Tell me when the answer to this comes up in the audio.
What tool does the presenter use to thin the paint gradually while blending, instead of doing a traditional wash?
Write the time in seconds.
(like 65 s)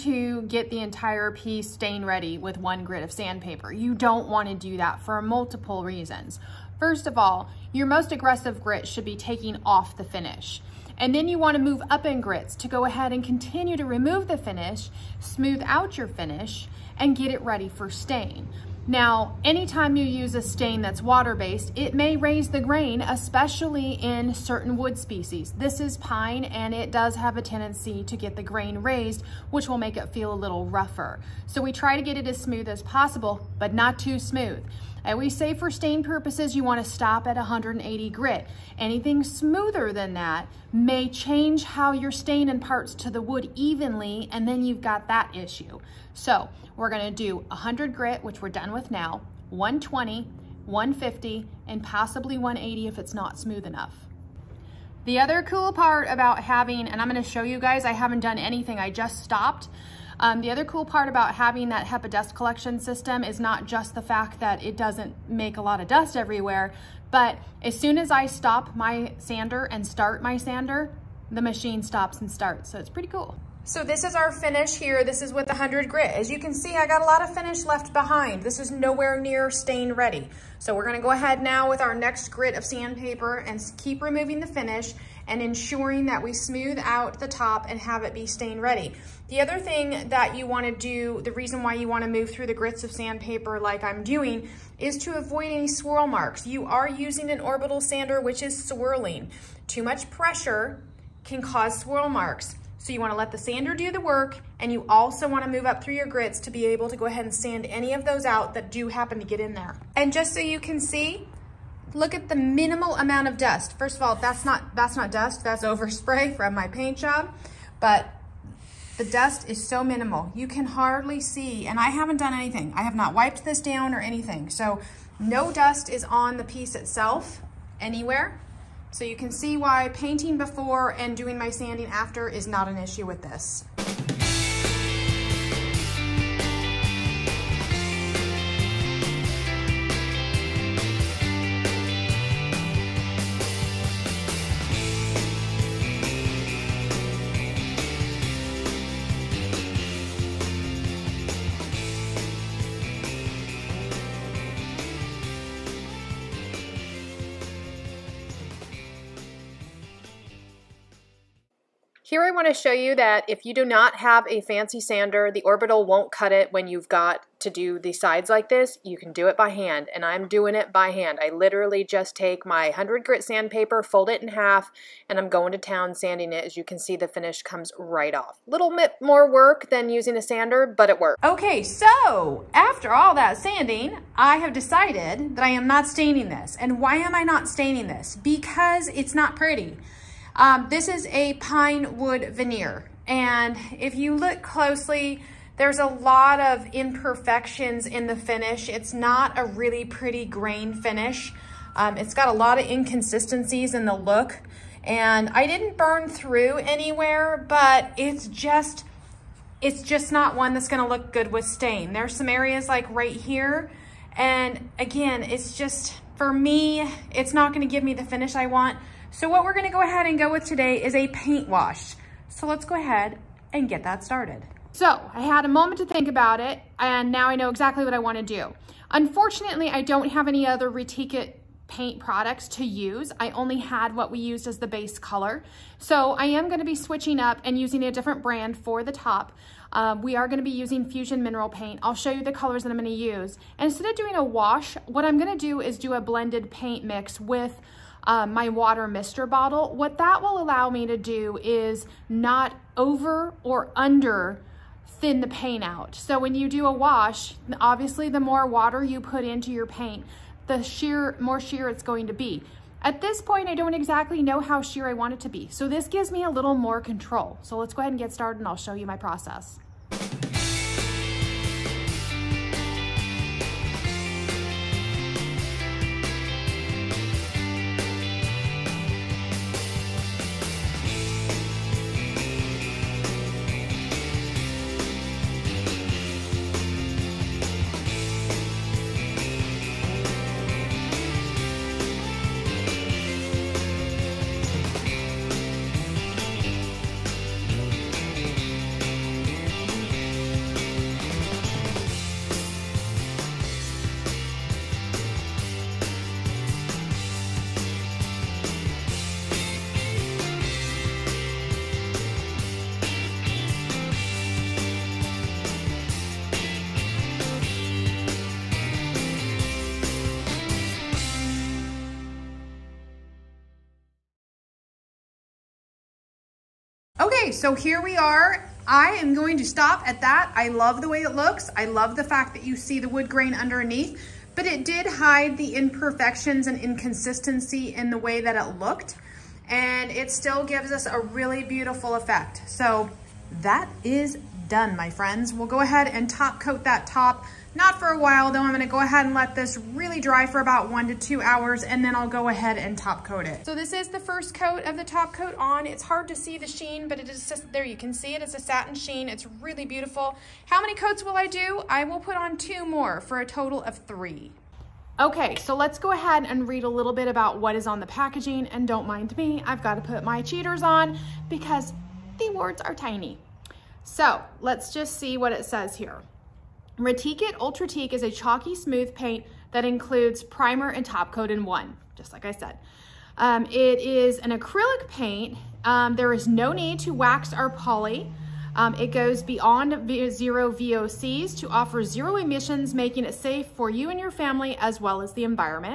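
248 s.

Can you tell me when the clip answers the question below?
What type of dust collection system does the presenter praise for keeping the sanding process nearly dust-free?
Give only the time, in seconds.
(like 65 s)
61 s.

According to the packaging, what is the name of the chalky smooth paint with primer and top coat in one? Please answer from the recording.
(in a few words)
Retique It Ultratique.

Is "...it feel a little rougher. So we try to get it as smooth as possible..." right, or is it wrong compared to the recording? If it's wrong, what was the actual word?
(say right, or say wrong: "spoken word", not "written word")
right.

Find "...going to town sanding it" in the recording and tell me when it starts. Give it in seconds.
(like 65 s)
175 s.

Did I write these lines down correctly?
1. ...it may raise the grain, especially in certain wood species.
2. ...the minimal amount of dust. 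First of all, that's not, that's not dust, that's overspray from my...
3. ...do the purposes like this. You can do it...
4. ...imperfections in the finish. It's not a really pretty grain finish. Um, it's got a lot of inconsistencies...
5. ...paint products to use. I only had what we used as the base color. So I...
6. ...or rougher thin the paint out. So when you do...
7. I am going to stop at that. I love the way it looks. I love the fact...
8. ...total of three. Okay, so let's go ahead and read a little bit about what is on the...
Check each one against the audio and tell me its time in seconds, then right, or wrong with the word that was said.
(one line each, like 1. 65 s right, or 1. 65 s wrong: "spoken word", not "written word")
1. 21 s right
2. 112 s right
3. 167 s wrong: "sides", not "purposes"
4. 196 s right
5. 231 s right
6. 253 s wrong: "under", not "rougher"
7. 328 s right
8. 363 s right.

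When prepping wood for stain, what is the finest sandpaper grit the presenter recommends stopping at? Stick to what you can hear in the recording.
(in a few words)
180 grit.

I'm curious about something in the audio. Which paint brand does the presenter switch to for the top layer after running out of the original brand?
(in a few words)
Fusion Mineral Paint.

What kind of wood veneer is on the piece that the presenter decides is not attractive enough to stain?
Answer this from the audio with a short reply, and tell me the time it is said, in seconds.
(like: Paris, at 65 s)
pine wood veneer, at 191 s.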